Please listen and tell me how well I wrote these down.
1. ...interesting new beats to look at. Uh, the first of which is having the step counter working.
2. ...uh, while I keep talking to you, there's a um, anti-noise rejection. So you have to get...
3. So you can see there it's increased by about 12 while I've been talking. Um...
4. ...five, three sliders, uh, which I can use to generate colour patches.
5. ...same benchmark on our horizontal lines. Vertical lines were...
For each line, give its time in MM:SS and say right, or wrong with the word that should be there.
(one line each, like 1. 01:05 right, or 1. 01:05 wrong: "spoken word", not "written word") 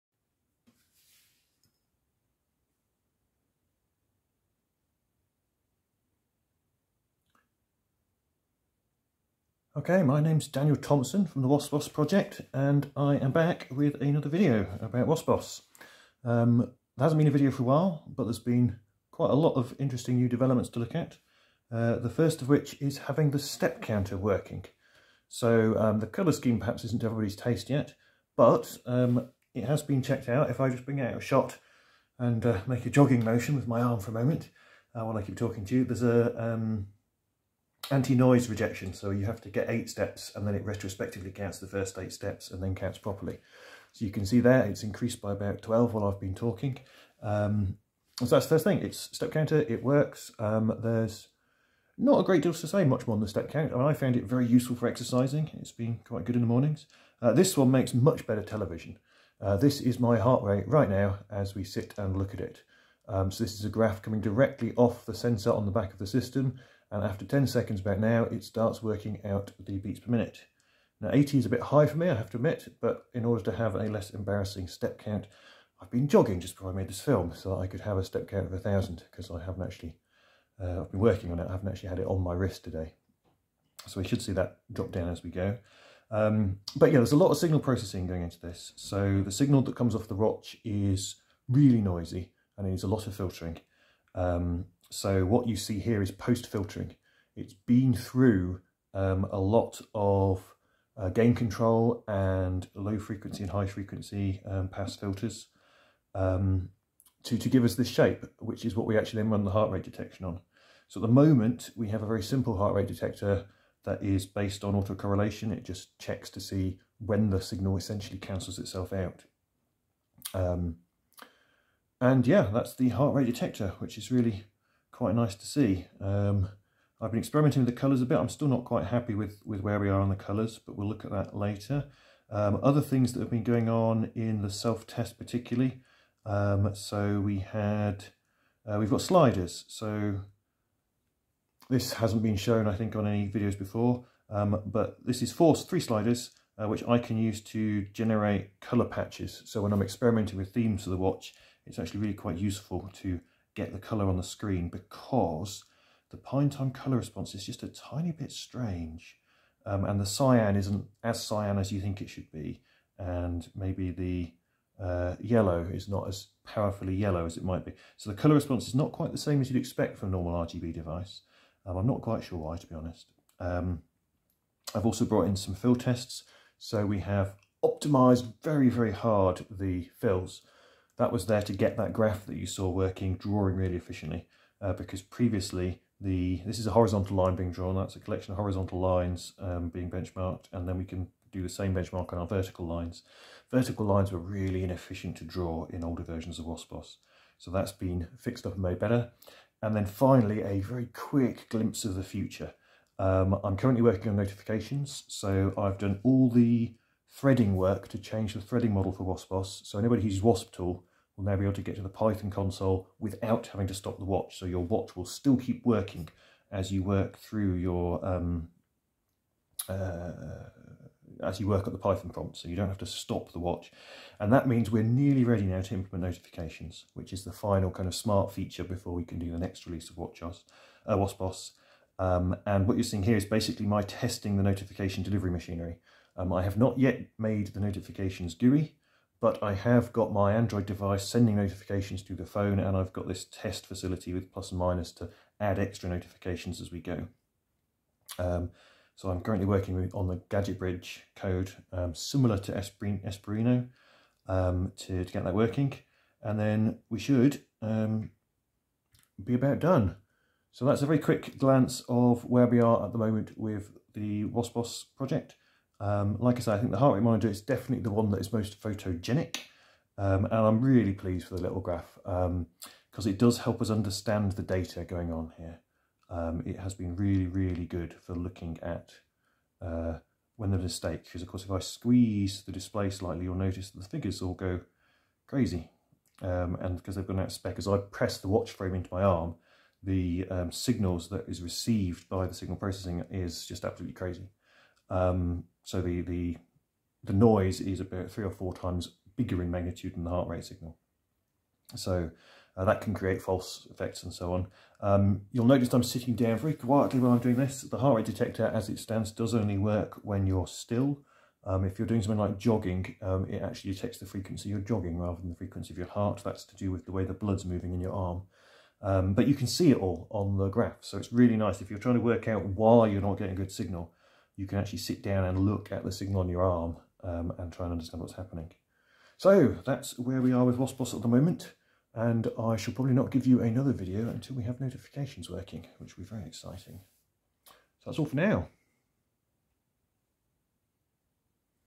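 1. 00:19 wrong: "developments", not "beats"
2. 00:34 right
3. 00:43 right
4. 02:25 wrong: "four", not "five"
5. 03:11 wrong: "vertical", not "horizontal".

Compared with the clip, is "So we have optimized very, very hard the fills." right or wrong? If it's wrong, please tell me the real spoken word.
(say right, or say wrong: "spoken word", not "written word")
right.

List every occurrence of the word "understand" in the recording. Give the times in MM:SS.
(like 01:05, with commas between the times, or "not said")
04:33, 05:27.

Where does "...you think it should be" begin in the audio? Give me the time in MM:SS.
02:41.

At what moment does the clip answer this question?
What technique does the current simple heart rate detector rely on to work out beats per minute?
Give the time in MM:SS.
01:54.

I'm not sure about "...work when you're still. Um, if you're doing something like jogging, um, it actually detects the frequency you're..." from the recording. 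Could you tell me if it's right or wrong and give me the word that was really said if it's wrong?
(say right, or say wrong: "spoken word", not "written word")
right.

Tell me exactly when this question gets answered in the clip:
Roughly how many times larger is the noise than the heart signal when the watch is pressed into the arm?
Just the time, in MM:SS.
04:58.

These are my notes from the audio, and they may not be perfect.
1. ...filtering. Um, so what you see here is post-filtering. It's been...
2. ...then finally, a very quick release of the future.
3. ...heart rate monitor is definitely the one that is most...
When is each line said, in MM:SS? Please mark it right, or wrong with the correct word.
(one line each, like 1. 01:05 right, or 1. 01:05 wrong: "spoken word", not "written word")
1. 01:33 right
2. 03:19 wrong: "glimpse", not "release"
3. 04:26 right.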